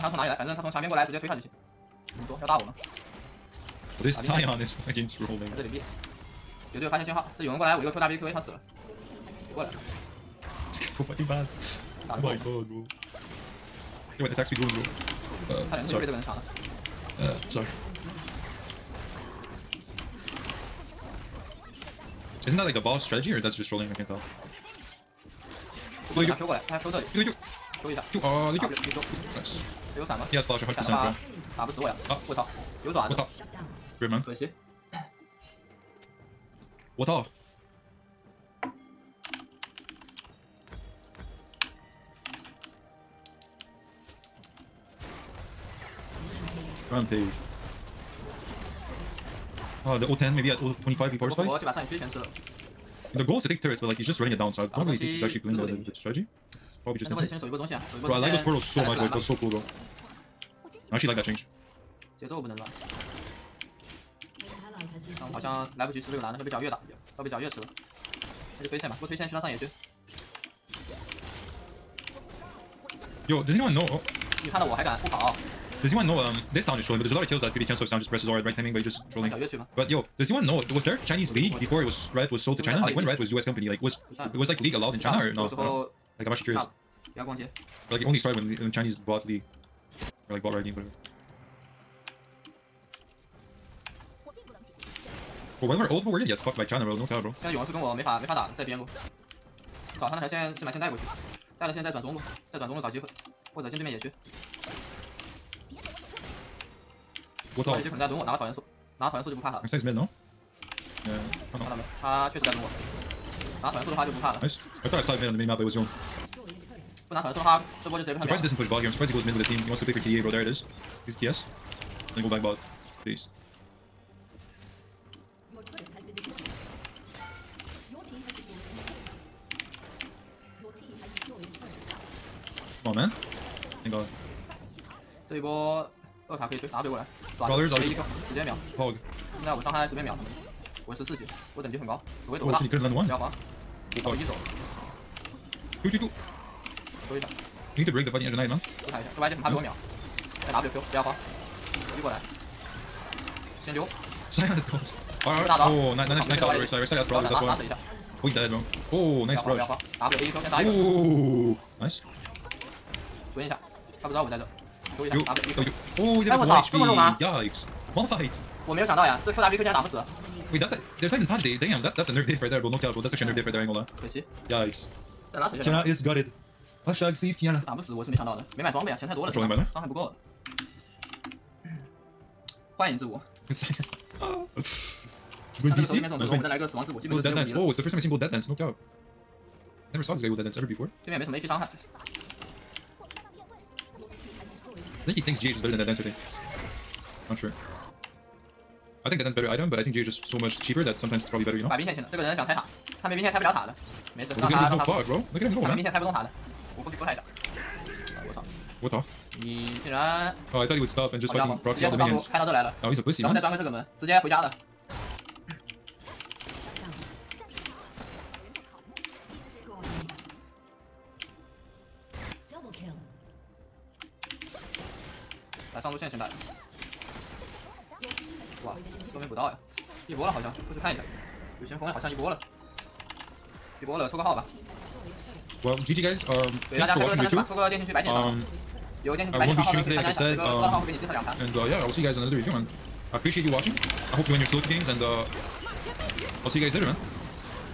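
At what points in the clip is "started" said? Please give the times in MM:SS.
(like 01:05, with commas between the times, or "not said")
01:28.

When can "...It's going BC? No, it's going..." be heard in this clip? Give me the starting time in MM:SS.
03:05.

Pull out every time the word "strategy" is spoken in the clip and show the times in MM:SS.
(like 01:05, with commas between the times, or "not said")
00:23, 00:55.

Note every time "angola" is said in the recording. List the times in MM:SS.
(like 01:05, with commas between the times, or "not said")
02:53.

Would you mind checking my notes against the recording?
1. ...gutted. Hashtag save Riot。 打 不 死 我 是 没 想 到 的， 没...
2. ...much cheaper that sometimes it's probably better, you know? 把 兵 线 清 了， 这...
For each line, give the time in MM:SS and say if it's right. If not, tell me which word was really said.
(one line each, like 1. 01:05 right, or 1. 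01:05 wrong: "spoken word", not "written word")
1. 02:56 wrong: "Kiana", not "Riot"
2. 03:20 right.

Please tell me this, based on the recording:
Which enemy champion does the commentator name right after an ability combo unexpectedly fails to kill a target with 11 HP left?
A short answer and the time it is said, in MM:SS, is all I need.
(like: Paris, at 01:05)
Malphite, at 02:47.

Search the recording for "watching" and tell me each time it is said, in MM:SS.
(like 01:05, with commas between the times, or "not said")
03:56, 04:03.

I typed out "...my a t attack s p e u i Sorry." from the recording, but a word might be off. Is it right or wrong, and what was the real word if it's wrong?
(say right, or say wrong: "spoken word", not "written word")
right.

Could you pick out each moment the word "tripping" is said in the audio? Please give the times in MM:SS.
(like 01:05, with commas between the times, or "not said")
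not said.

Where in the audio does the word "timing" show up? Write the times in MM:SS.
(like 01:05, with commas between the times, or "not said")
01:18.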